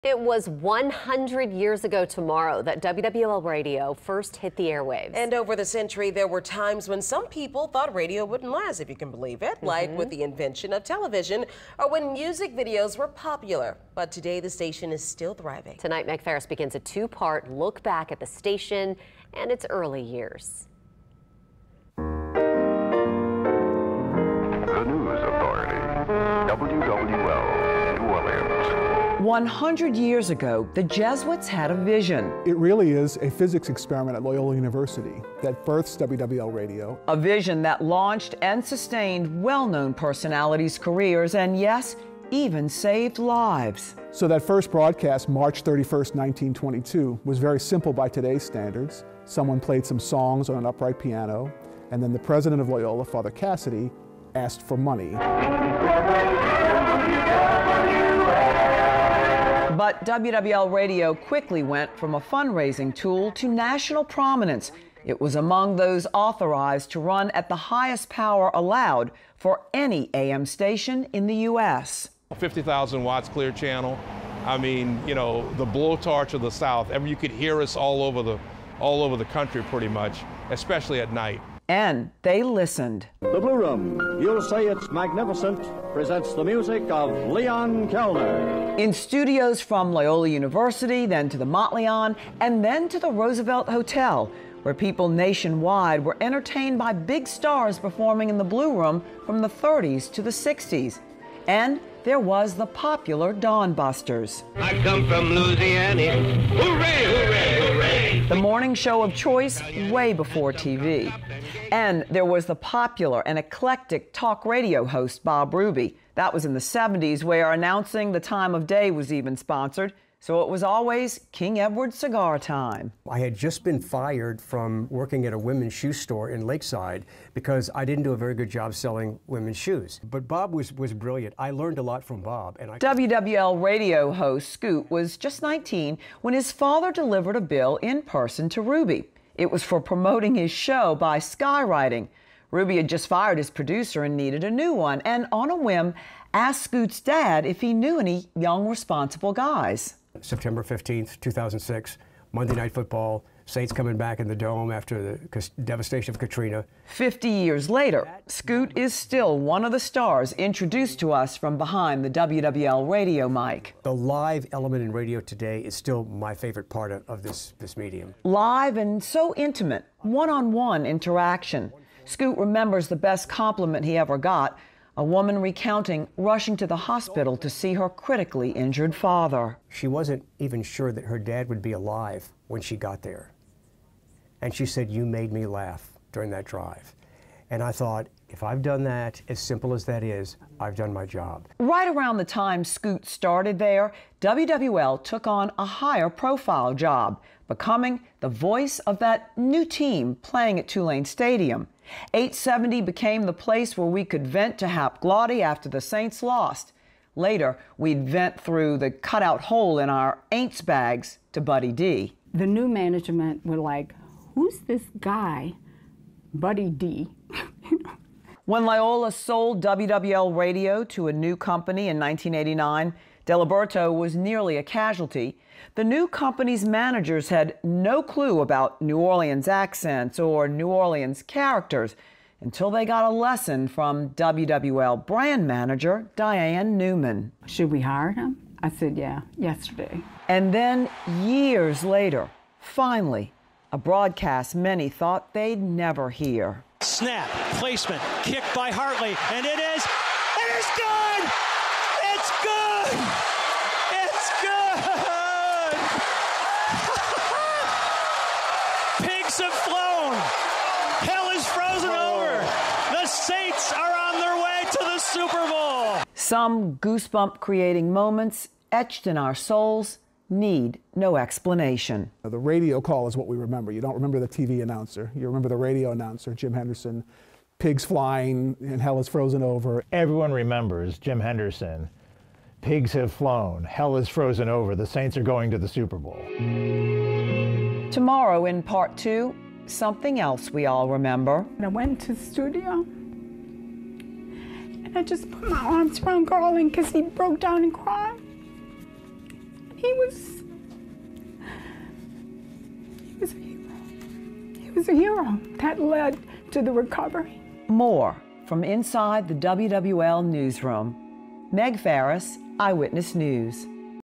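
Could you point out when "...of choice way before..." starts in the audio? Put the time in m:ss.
1:49.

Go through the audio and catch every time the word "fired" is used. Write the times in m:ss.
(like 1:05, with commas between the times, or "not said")
2:03, 2:23.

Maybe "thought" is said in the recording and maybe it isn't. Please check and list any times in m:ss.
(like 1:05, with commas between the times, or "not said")
0:07, 3:07, 4:04.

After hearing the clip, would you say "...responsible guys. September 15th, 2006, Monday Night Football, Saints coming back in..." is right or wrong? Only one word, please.
right.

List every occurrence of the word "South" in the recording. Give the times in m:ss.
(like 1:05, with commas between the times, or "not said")
1:16.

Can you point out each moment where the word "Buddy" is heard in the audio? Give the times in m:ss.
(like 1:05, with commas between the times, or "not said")
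3:31, 3:36.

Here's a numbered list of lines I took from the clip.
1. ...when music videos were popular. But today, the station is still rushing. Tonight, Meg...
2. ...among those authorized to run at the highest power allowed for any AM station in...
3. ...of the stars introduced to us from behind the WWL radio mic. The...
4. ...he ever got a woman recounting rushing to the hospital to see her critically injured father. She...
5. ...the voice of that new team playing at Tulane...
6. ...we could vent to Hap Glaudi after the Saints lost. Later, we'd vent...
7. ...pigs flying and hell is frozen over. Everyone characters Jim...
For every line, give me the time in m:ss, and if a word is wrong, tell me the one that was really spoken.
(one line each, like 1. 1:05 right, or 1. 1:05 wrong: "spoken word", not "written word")
1. 0:11 wrong: "thriving", not "rushing"
2. 1:05 right
3. 2:39 right
4. 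2:53 right
5. 3:18 right
6. 3:23 right
7. 4:37 wrong: "remembers", not "characters".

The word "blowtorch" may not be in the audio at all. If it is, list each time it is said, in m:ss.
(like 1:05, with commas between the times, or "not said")
1:15.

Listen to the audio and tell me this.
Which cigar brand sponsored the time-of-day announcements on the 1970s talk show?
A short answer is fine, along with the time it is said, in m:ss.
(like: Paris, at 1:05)
King Edward, at 2:01.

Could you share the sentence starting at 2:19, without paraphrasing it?
It was for promoting his show by skywriting.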